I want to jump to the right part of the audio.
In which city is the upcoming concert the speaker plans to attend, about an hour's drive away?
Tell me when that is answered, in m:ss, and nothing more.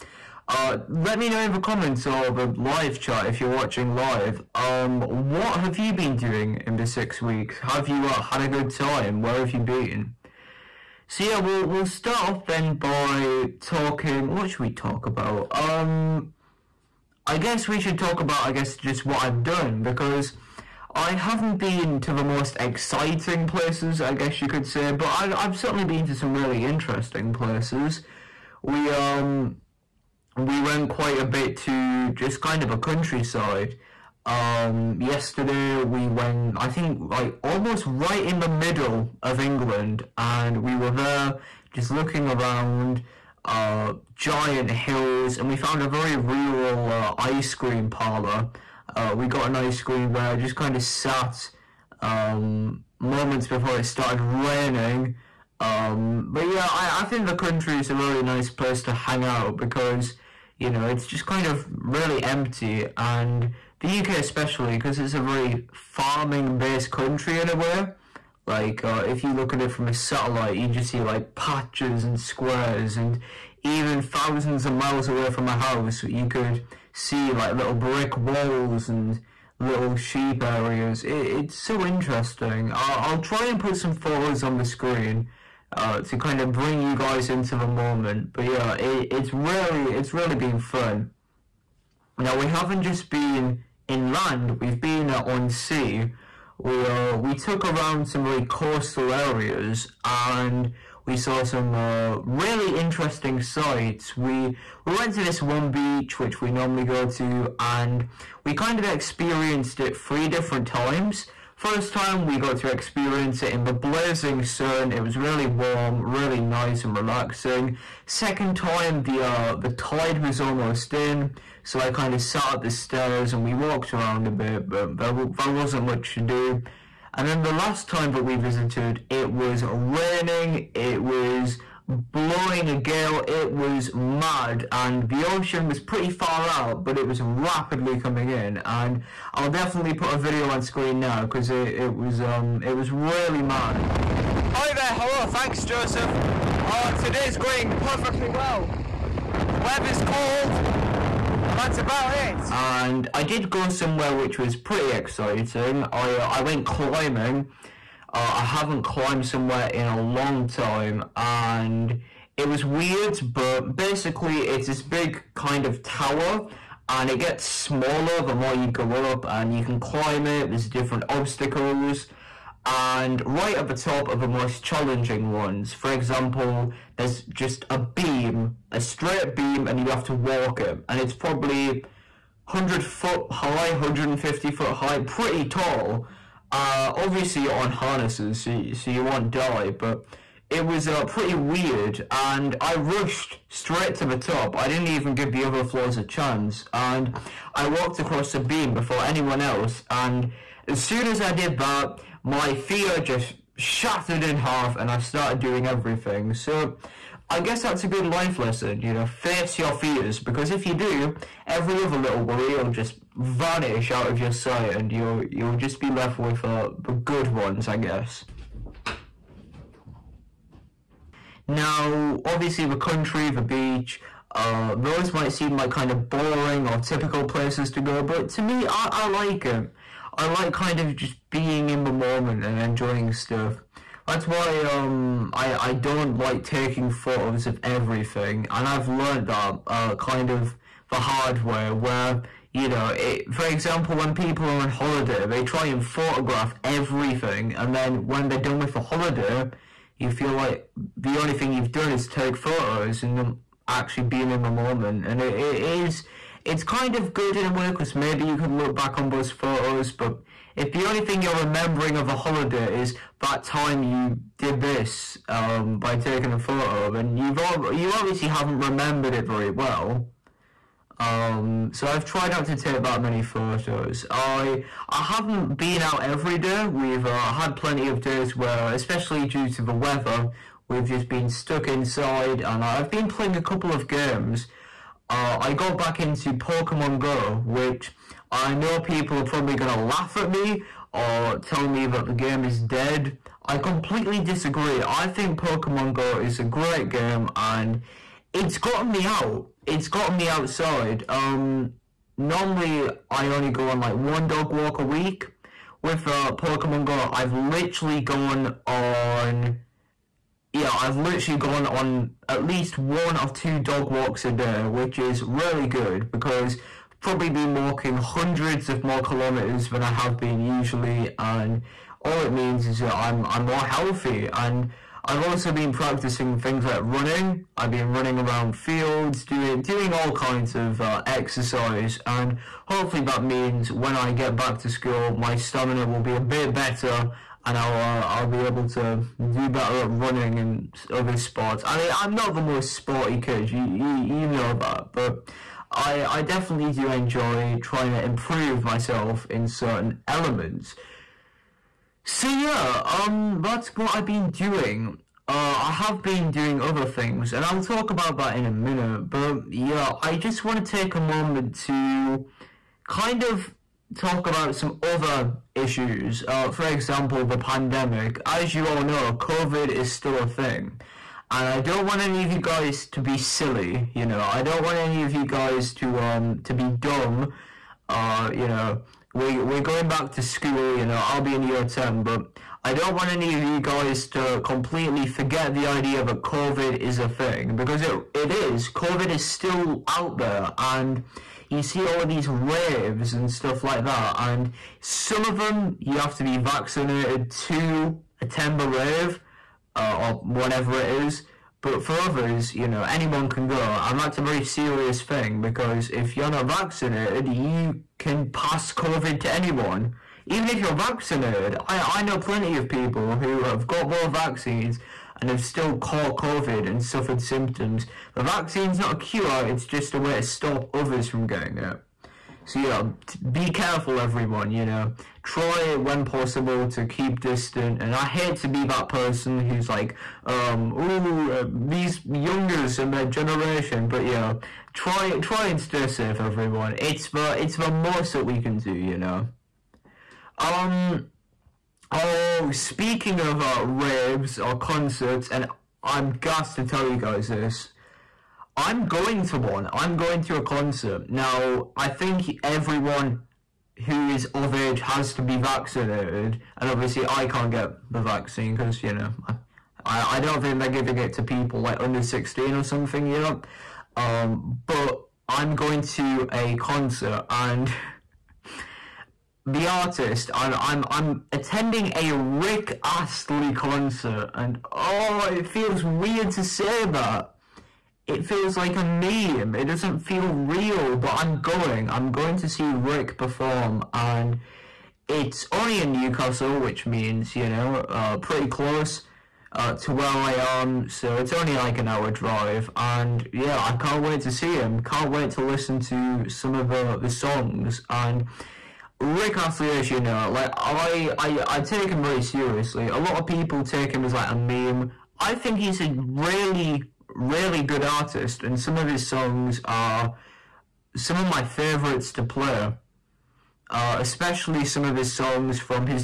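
8:05.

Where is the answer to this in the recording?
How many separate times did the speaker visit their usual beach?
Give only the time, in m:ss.
1:49.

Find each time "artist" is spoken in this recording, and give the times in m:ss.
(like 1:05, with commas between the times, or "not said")
7:49, 8:27.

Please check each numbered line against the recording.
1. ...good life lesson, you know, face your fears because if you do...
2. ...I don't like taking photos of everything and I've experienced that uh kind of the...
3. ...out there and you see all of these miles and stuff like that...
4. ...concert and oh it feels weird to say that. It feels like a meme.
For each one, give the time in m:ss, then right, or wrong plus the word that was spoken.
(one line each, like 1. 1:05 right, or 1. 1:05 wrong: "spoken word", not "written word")
1. 3:27 right
2. 3:55 wrong: "learned", not "experienced"
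3. 6:29 wrong: "raves", not "miles"
4. 7:53 right.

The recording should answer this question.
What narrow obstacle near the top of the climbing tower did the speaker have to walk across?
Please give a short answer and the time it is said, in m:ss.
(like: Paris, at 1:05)
A beam, at 2:58.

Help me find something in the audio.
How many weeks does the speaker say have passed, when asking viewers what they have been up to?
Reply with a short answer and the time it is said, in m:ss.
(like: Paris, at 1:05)
6, at 0:06.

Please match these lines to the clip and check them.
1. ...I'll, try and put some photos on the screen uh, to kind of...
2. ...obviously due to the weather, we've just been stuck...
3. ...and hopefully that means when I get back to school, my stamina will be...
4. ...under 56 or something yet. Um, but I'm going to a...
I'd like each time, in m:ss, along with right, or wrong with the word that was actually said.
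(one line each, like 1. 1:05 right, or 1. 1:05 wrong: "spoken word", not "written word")
1. 1:23 right
2. 4:38 wrong: "especially", not "obviously"
3. 5:32 right
4. 7:41 wrong: "16", not "56".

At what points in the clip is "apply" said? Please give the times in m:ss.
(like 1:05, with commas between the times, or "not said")
not said.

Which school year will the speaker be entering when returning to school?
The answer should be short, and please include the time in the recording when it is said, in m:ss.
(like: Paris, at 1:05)
Year 10, at 6:21.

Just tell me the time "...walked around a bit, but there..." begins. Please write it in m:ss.
2:03.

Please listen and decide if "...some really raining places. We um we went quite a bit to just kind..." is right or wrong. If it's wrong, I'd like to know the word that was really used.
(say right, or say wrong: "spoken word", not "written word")
wrong: "interesting", not "raining".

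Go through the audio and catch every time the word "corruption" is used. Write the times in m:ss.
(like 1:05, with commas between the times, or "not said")
not said.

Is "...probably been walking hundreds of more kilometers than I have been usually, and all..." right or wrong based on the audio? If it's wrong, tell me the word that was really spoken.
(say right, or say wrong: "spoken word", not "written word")
right.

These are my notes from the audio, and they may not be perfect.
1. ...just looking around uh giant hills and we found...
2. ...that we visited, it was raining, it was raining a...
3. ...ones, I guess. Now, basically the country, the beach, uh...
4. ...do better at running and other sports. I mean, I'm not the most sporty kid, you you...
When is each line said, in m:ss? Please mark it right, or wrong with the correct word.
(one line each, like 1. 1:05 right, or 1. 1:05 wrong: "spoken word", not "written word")
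1. 0:41 right
2. 2:08 wrong: "blowing", not "raining"
3. 3:37 wrong: "obviously", not "basically"
4. 5:39 right.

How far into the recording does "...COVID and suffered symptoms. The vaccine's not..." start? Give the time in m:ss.
6:56.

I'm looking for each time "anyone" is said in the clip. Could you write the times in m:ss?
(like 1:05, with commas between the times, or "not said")
3:19, 6:42, 6:49.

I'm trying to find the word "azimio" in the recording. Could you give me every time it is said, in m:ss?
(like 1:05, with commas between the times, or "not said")
not said.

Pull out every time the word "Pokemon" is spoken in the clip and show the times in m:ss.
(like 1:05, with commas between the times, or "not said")
4:46, 4:55, 5:06.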